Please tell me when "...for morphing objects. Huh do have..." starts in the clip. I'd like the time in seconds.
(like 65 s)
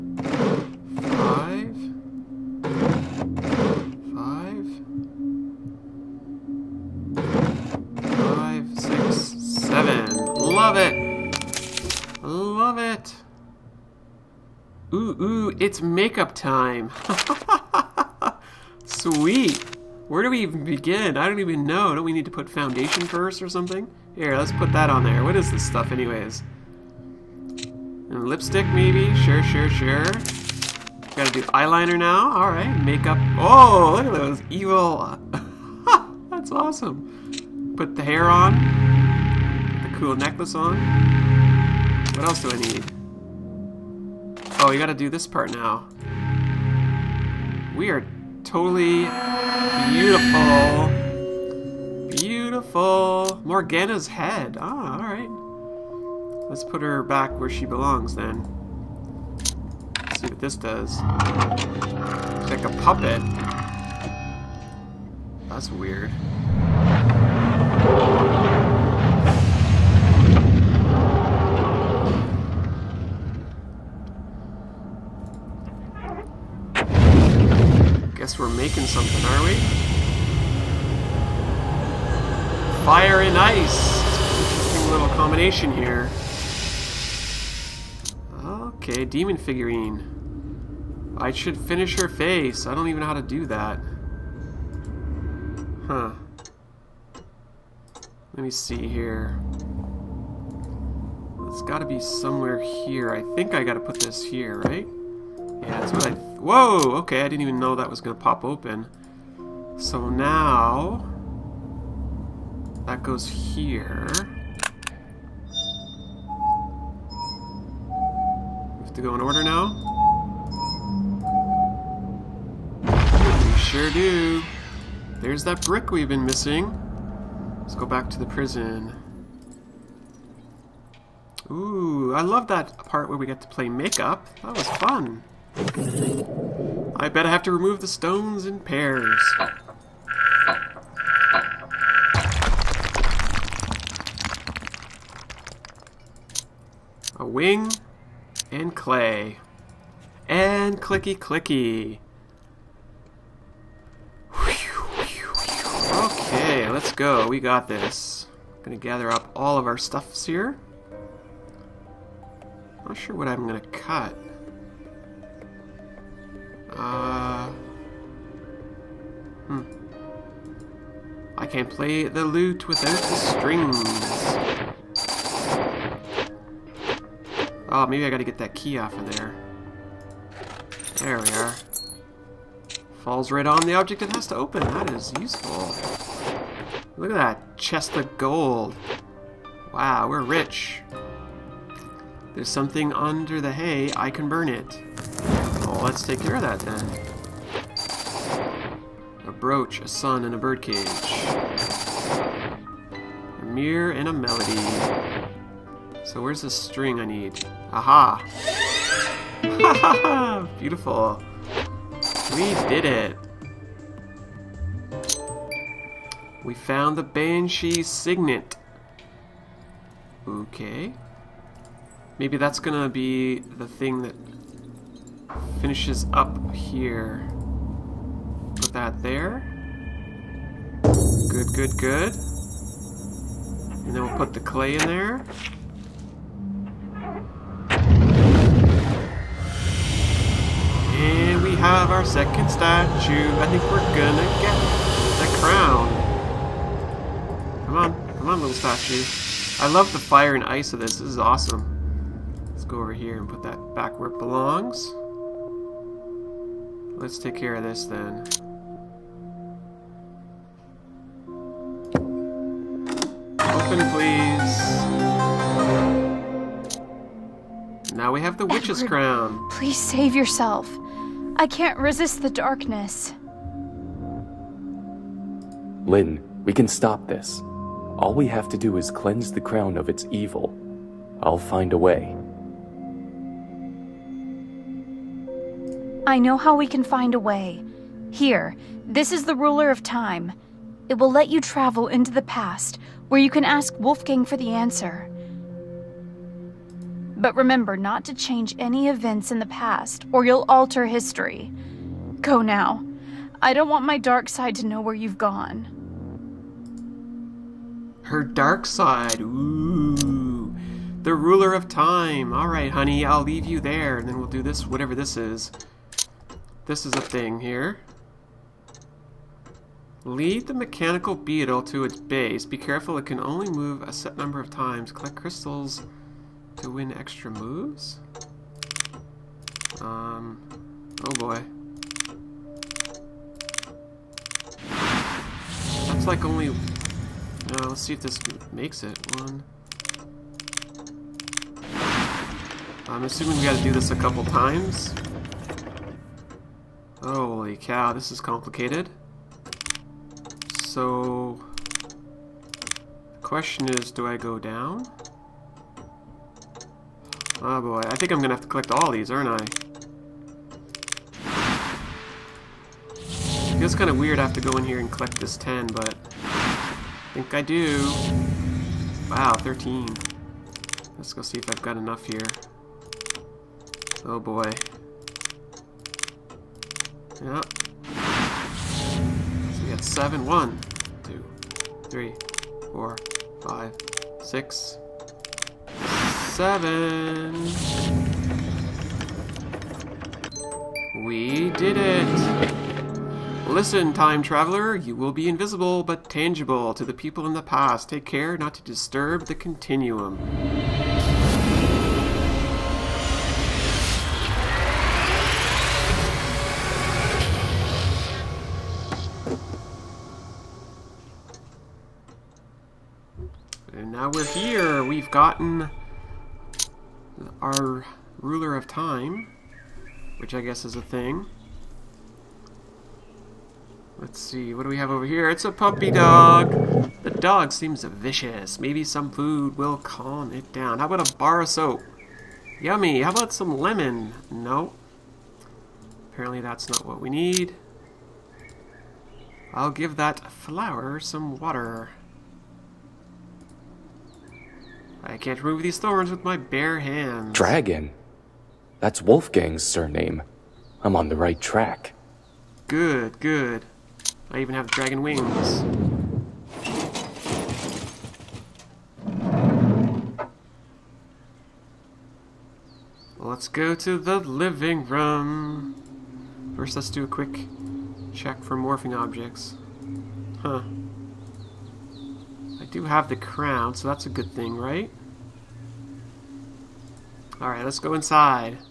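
468 s.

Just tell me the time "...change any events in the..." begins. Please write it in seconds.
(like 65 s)
298 s.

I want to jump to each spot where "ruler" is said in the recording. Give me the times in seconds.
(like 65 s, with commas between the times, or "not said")
289 s, 311 s, 418 s.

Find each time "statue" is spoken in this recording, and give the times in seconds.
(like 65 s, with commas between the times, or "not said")
242 s, 248 s.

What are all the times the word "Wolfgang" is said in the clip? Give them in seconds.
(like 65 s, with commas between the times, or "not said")
293 s, 449 s.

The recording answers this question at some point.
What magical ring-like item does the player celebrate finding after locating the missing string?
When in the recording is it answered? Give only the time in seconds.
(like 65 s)
217 s.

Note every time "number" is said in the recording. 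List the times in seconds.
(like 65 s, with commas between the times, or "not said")
324 s.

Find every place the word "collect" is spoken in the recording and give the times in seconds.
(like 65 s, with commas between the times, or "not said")
324 s, 358 s, 364 s.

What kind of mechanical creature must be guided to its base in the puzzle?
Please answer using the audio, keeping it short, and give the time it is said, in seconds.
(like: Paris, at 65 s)
Beetle, at 320 s.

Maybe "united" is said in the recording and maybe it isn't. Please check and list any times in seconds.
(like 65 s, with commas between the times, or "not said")
not said.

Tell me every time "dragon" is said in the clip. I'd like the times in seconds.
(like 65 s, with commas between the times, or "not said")
447 s, 454 s.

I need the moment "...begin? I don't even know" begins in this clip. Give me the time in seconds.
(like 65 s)
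20 s.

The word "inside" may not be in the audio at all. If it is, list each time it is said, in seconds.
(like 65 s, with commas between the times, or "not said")
477 s.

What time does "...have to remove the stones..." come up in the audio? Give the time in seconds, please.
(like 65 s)
137 s.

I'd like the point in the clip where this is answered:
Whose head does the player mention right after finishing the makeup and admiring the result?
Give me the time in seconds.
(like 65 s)
53 s.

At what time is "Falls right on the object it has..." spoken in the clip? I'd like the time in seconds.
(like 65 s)
183 s.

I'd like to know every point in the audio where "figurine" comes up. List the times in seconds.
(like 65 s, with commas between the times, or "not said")
89 s.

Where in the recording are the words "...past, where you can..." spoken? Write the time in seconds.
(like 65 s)
292 s.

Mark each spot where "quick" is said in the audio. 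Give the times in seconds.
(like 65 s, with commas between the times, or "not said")
467 s.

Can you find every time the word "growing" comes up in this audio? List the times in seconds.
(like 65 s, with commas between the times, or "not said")
not said.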